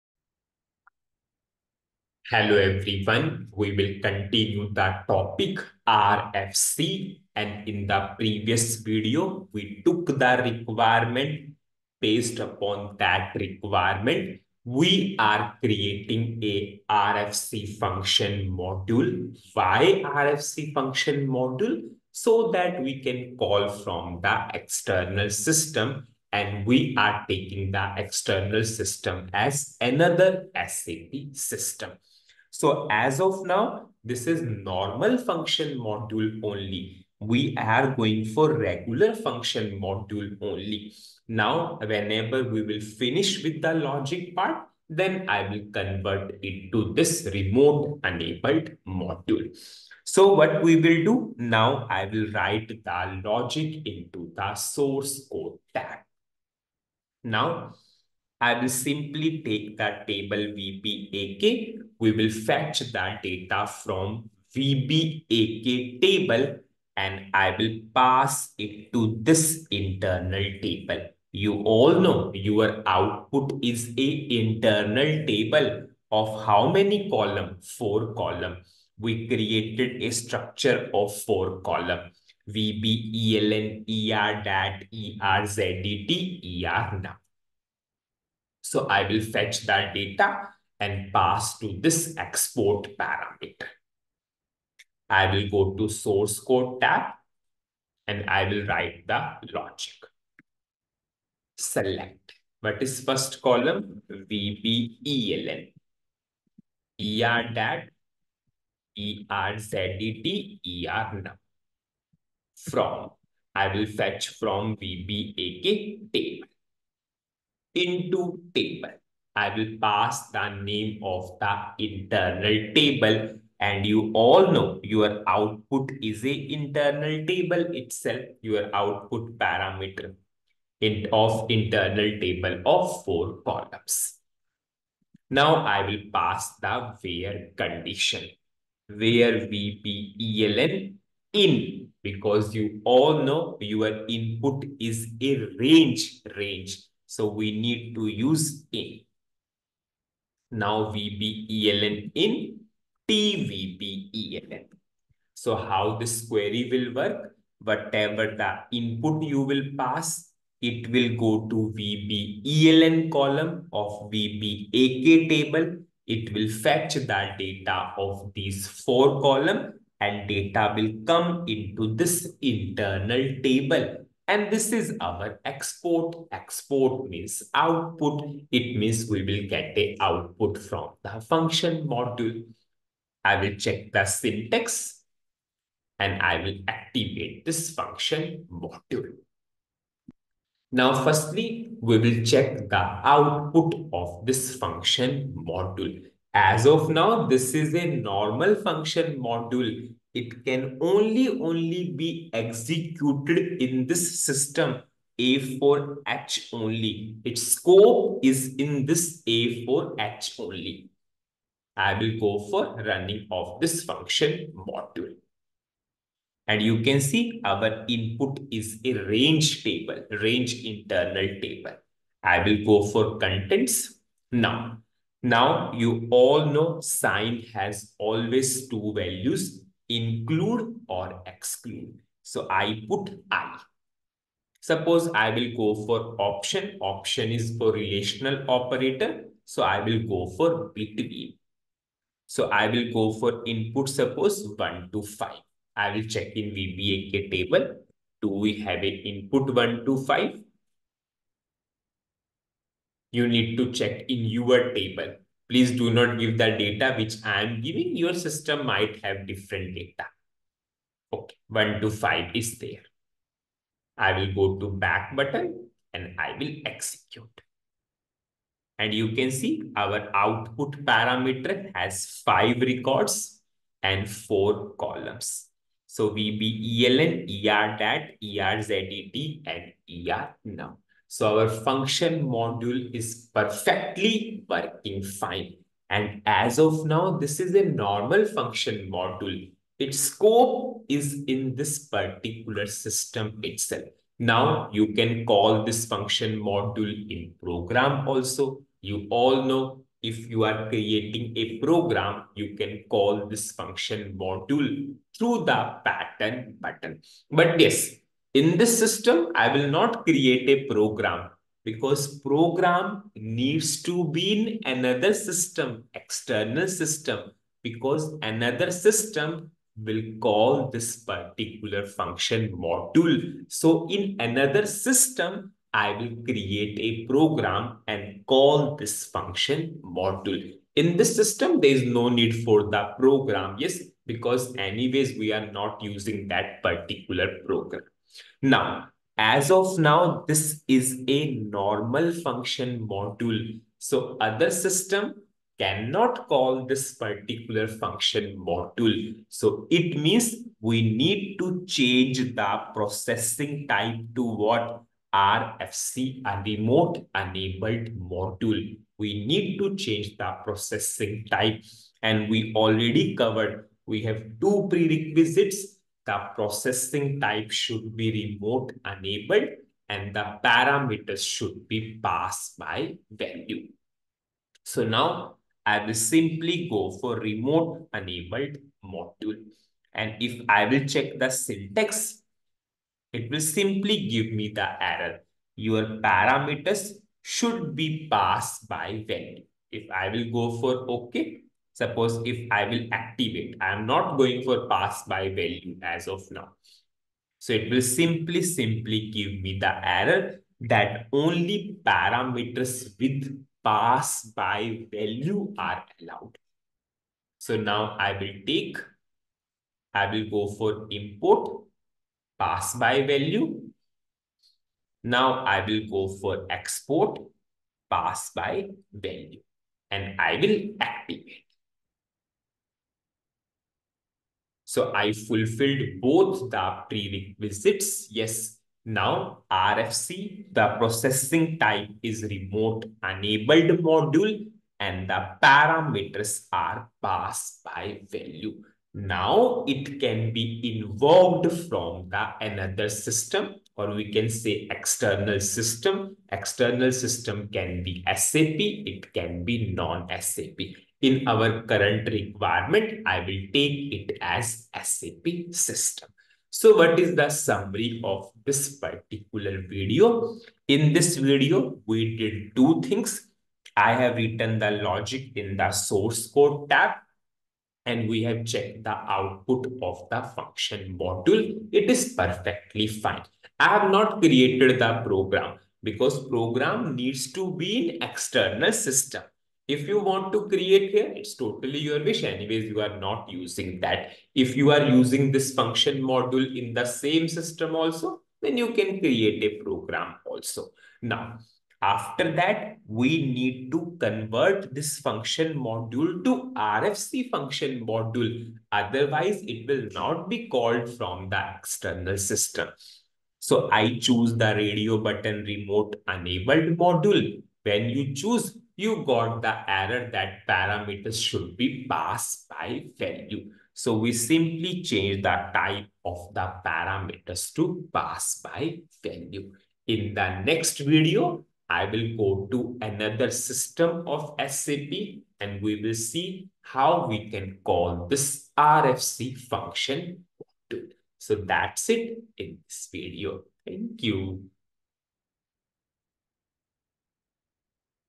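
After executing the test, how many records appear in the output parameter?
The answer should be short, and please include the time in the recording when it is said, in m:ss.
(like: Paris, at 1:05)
5, at 4:32.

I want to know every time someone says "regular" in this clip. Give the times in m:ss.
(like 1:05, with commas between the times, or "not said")
0:38.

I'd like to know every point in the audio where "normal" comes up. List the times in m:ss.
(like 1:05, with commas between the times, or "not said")
0:34, 3:17, 4:47, 5:41.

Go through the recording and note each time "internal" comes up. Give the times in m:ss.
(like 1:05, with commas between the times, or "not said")
1:09, 1:14, 2:01, 2:06, 2:11, 2:52, 3:40.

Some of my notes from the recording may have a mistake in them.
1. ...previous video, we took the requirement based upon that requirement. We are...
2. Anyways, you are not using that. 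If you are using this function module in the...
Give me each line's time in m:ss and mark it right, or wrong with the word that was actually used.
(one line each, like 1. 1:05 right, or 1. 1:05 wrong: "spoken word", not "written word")
1. 0:08 right
2. 8:02 right.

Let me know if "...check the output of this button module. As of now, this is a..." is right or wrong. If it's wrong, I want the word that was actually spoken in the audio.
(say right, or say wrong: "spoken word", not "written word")
wrong: "function", not "button".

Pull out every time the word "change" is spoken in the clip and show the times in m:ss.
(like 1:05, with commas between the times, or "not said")
5:51, 5:59, 8:34.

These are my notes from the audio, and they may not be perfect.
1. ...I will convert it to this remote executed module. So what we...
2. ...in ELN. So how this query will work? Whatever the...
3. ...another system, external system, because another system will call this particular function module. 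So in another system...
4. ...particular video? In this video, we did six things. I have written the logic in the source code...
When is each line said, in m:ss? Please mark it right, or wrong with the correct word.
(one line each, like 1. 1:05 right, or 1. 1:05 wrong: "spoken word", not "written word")
1. 0:45 wrong: "enabled", not "executed"
2. 2:32 wrong: "TVPELN", not "ELN"
3. 5:14 right
4. 7:38 wrong: "two", not "six".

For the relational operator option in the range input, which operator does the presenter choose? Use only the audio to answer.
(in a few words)
Between.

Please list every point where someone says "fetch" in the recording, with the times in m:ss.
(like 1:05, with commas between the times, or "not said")
1:02, 1:29, 1:53, 2:46.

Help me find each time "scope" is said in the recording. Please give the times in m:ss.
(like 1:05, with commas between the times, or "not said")
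3:27, 4:49.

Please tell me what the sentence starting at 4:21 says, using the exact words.
Okay, 1 to 5 is there.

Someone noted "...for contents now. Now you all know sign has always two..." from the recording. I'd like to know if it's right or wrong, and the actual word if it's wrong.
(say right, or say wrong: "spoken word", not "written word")
right.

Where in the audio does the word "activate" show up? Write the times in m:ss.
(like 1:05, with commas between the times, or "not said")
3:06, 6:32, 7:00.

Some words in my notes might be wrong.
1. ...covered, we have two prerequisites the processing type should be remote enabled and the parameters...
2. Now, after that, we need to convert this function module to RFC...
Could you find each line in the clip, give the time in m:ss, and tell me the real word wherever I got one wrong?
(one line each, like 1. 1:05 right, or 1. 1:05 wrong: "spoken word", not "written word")
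1. 6:03 right
2. 8:11 right.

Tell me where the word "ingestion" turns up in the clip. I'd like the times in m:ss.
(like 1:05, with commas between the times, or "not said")
not said.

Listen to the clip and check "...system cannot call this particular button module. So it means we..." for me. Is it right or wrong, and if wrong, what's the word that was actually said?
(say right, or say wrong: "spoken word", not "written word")
wrong: "function", not "button".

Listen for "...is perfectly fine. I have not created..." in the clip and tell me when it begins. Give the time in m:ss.
7:51.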